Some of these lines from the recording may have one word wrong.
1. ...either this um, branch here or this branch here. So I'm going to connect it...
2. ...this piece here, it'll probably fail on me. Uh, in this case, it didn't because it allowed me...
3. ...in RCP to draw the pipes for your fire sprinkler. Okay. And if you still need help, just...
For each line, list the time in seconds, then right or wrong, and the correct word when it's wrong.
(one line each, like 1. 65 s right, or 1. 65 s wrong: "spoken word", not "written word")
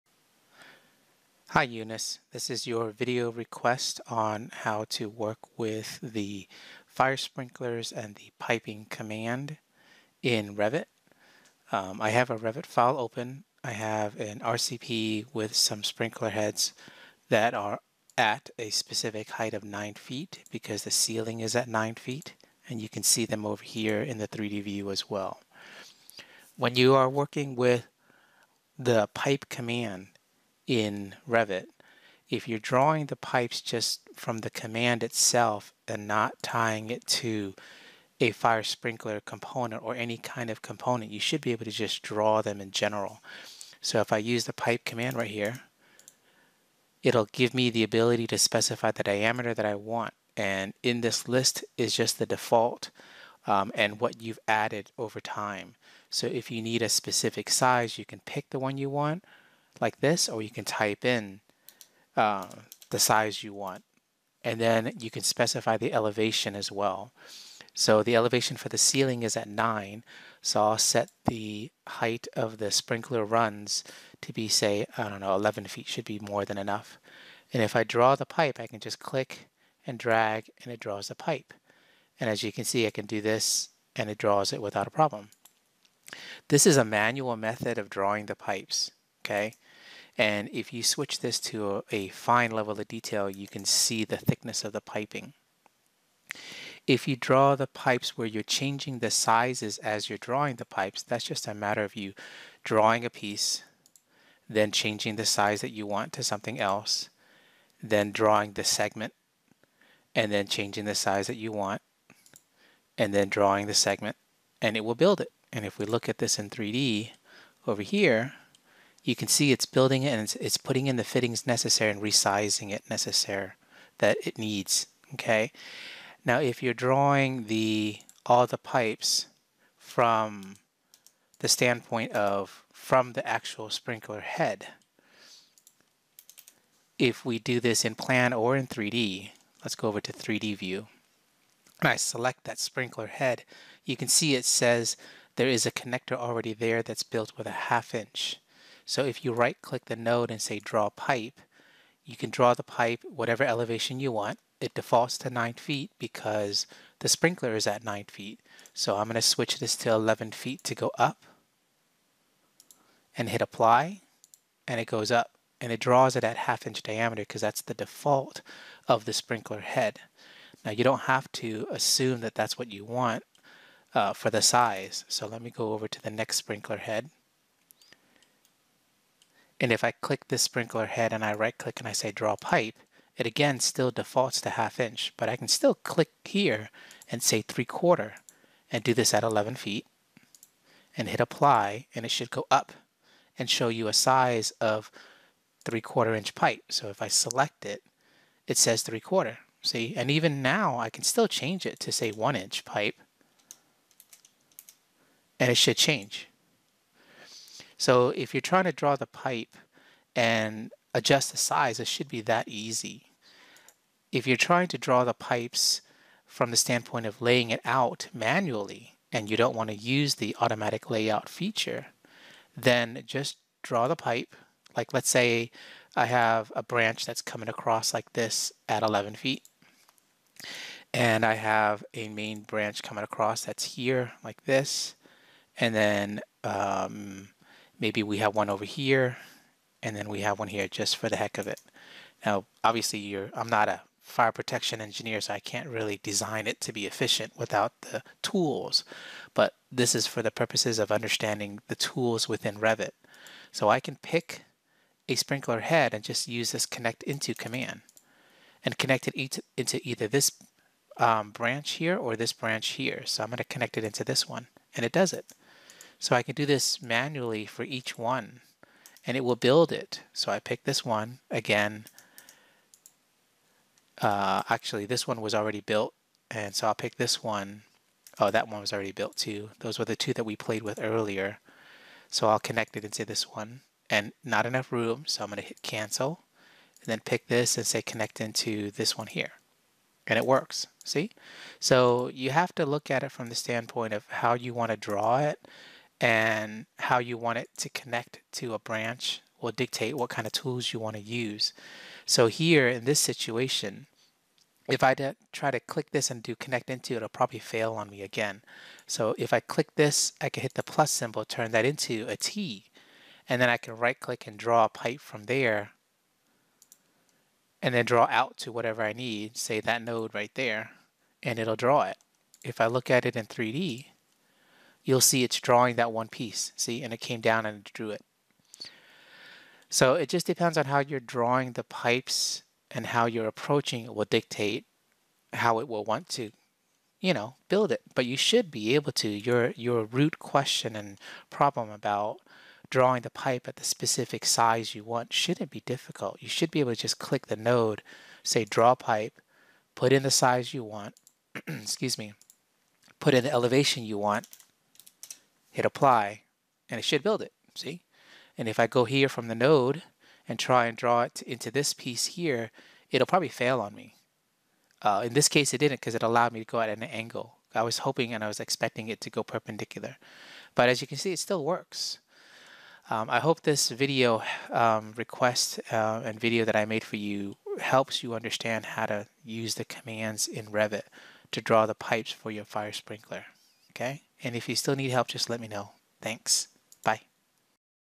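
1. 259 s right
2. 361 s right
3. 380 s wrong: "Revit", not "RCP".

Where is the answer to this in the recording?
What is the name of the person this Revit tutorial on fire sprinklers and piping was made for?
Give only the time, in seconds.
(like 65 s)
1 s.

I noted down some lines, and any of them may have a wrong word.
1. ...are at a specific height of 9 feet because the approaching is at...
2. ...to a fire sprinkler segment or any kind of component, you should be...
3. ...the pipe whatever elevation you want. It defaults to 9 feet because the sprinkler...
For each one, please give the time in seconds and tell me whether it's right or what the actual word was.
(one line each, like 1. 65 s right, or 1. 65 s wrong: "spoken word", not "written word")
1. 17 s wrong: "ceiling", not "approaching"
2. 37 s wrong: "component", not "segment"
3. 152 s right.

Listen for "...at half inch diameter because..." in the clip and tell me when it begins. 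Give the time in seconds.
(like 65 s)
166 s.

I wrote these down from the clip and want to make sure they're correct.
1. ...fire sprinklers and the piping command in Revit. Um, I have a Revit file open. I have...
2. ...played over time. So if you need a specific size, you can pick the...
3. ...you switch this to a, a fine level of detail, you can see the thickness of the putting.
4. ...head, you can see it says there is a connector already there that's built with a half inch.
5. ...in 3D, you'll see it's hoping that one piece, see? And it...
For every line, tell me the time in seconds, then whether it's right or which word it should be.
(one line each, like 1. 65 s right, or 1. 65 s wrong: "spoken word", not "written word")
1. 6 s right
2. 54 s wrong: "added", not "played"
3. 90 s wrong: "piping", not "putting"
4. 143 s right
5. 323 s wrong: "drawing", not "hoping".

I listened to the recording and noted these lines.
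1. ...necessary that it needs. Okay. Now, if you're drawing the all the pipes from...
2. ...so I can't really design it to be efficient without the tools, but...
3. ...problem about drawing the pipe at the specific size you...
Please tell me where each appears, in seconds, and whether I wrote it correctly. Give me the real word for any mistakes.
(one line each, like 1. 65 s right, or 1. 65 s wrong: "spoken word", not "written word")
1. 122 s right
2. 245 s right
3. 341 s right.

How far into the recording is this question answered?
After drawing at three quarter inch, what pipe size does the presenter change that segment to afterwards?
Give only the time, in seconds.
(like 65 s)
202 s.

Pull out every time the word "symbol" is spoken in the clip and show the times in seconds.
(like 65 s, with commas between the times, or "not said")
310 s.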